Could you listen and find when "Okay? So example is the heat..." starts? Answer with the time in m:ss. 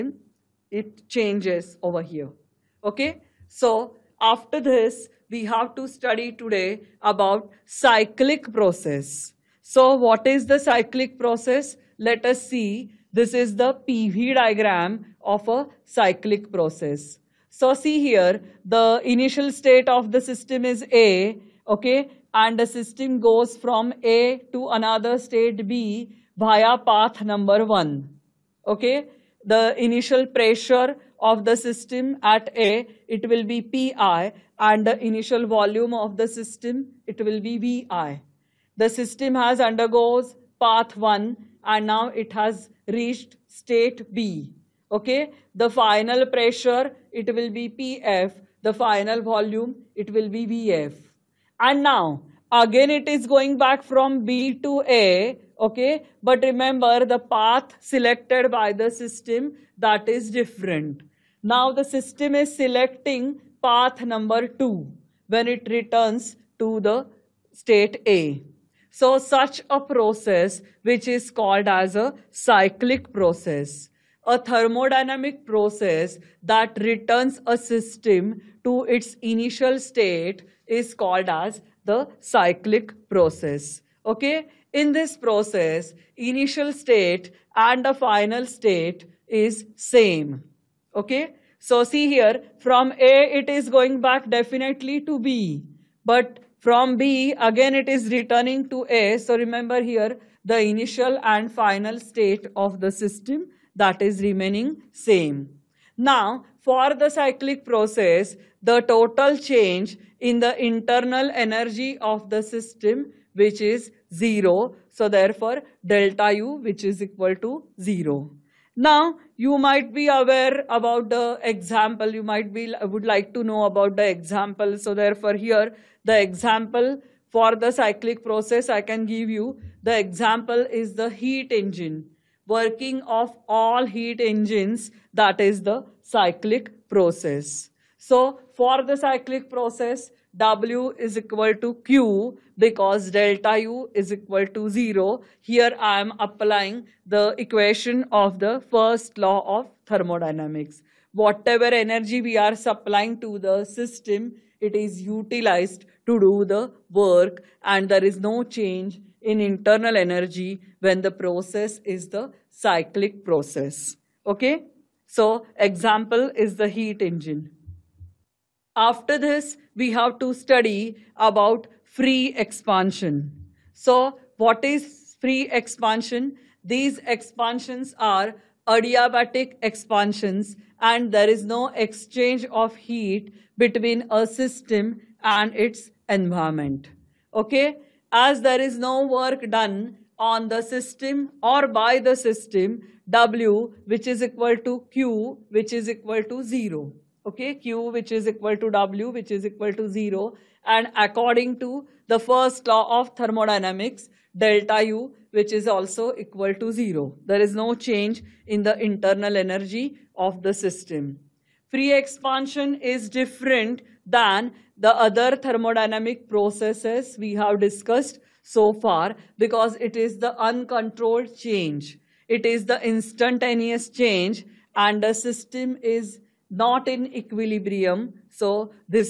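2:44.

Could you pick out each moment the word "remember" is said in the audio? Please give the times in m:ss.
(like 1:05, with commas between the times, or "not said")
0:56, 1:39.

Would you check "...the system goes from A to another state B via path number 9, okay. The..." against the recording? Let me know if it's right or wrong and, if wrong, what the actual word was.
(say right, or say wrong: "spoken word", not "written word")
wrong: "1", not "9".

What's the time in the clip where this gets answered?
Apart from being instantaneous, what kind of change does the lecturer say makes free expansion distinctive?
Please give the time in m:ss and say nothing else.
3:40.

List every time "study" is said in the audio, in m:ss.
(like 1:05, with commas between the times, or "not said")
0:05, 2:50.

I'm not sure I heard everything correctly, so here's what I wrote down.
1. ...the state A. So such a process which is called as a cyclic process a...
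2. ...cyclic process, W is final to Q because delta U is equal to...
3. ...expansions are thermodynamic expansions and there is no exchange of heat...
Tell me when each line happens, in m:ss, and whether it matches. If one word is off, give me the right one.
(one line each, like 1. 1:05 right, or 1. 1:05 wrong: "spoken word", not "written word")
1. 1:06 right
2. 2:18 wrong: "equal", not "final"
3. 2:57 wrong: "adiabatic", not "thermodynamic".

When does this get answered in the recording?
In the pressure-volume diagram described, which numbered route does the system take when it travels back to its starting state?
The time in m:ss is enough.
1:03.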